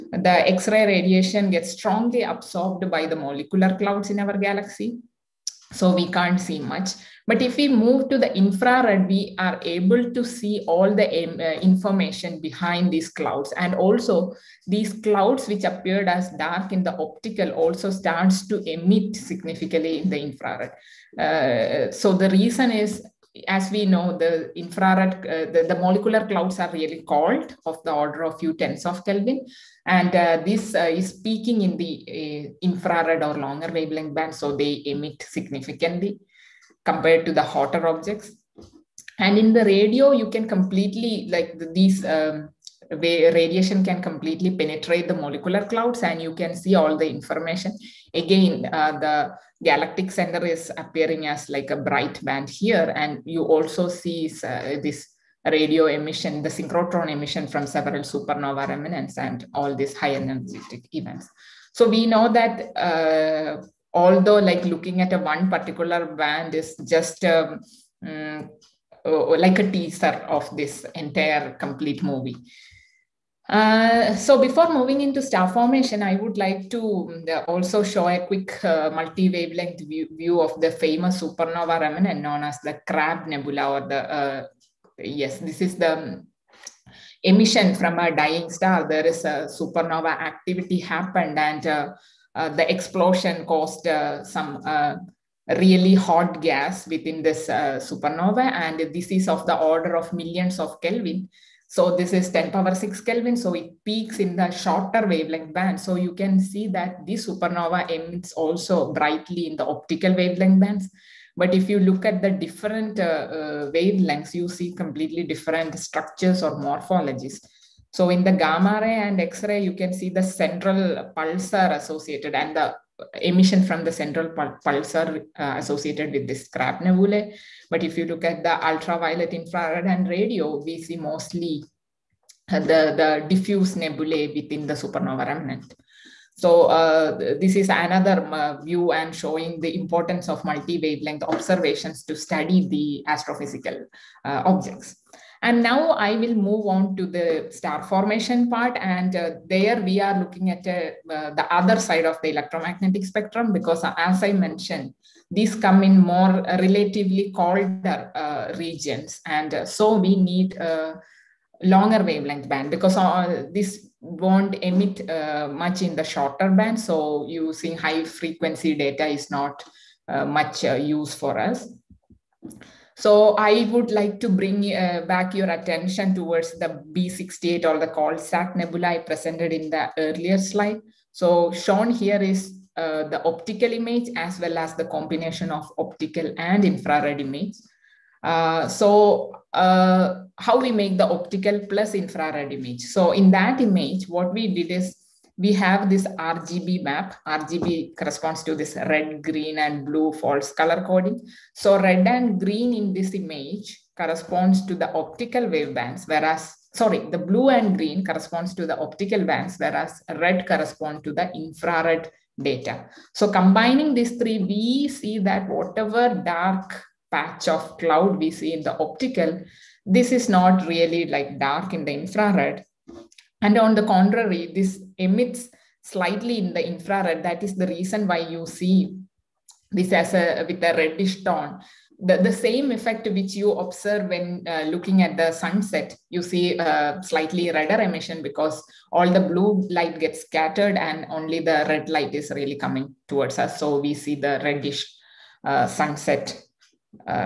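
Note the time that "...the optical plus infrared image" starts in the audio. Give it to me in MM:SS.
03:10.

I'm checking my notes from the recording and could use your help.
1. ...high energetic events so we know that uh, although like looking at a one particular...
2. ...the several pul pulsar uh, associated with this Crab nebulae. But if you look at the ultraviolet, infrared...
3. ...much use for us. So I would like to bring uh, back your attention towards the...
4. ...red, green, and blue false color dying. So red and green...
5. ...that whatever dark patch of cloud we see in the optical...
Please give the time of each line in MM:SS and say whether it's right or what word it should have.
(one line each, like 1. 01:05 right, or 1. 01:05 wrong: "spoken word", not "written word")
1. 00:59 right
2. 02:03 wrong: "central", not "several"
3. 02:50 right
4. 03:18 wrong: "coding", not "dying"
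5. 03:35 right.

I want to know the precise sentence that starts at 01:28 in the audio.
There is a supernova activity happened and uh, uh, the explosion caused uh, some really hot gas within this supernova.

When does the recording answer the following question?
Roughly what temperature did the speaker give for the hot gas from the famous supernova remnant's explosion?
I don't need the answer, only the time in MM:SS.
01:42.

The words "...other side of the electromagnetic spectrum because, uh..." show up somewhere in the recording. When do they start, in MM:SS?
02:31.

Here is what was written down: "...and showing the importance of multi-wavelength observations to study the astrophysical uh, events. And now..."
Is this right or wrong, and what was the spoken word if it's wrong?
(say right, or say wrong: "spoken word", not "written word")
wrong: "objects", not "events".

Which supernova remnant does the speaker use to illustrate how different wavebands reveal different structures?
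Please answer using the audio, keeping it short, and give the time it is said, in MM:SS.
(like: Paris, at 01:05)
Crab Nebula, at 01:22.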